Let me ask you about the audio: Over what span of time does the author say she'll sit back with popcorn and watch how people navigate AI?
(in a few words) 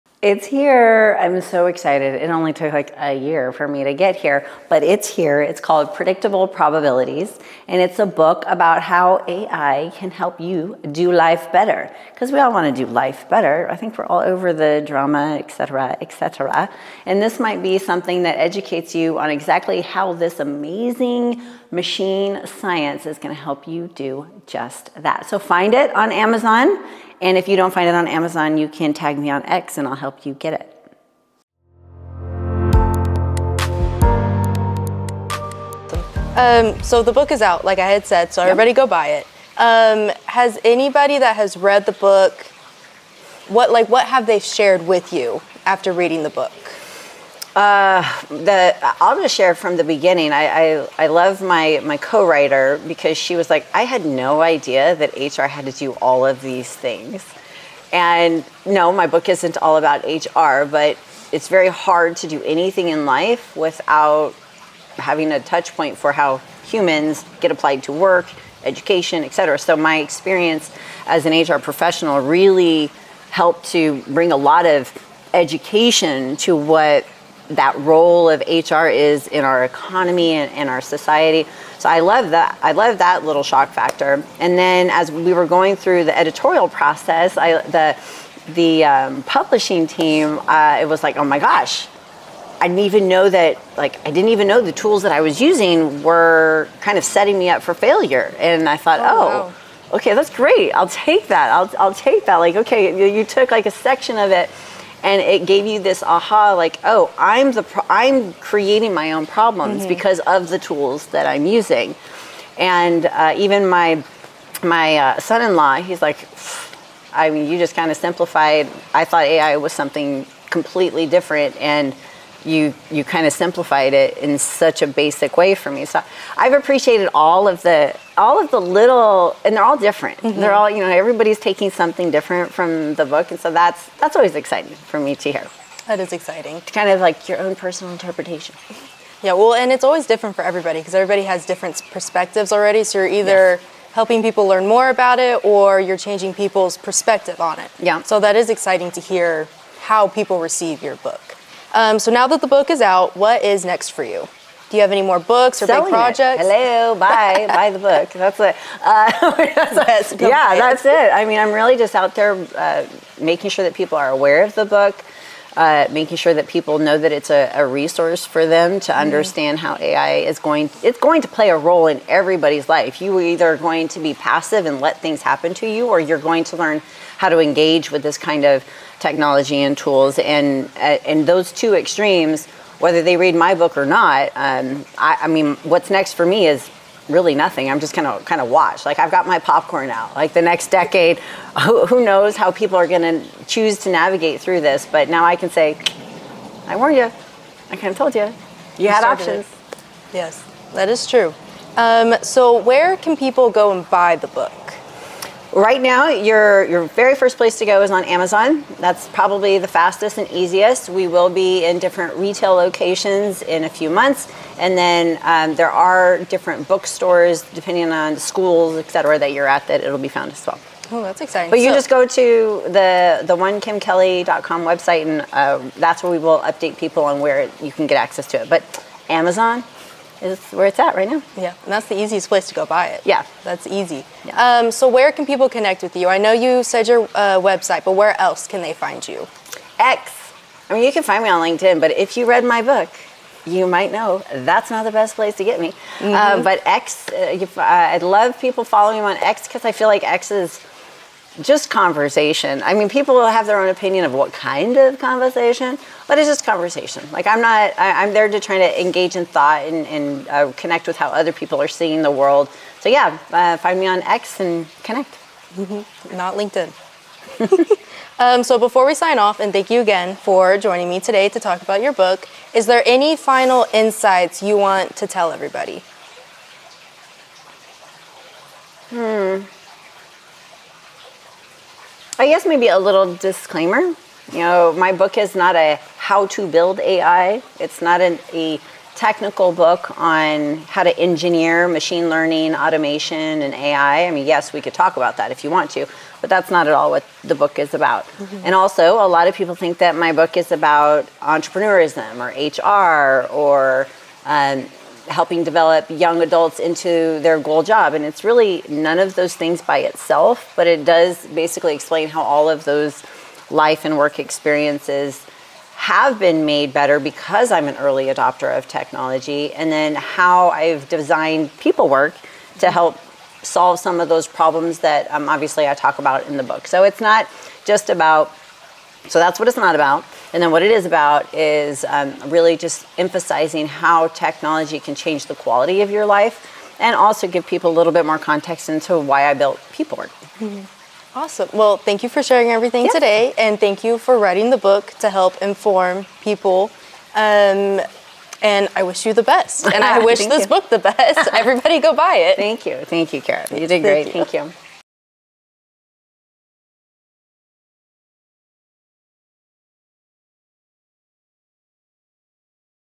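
the next decade.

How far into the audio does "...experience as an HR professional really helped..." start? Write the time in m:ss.
1:09.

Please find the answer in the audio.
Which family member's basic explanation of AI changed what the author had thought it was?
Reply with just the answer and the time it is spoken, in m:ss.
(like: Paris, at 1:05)
son-in-law, at 1:55.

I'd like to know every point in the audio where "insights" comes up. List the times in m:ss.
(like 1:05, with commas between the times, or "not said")
4:33.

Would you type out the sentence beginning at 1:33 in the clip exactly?
Like I didn't even know the tools that I was using were kind of setting me up for failure.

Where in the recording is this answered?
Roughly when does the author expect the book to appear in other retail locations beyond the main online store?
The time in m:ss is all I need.
3:33.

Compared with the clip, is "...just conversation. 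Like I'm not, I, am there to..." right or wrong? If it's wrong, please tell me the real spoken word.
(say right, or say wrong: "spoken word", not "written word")
right.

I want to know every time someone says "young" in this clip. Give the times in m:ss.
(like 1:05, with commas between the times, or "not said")
5:05.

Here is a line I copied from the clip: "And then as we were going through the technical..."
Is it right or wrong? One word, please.
wrong.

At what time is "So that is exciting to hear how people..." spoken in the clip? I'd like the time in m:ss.
2:28.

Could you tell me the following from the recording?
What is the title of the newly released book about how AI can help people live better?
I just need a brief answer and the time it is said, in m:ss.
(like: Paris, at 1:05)
Predictable Probabilities, at 0:05.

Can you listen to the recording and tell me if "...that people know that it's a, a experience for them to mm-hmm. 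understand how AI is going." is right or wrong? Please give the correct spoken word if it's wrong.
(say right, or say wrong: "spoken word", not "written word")
wrong: "resource", not "experience".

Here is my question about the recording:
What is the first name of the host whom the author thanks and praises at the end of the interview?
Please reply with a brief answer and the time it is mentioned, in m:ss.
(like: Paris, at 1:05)
Kara, at 5:53.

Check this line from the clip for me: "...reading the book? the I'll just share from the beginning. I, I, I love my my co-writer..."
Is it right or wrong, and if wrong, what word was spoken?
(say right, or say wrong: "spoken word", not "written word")
right.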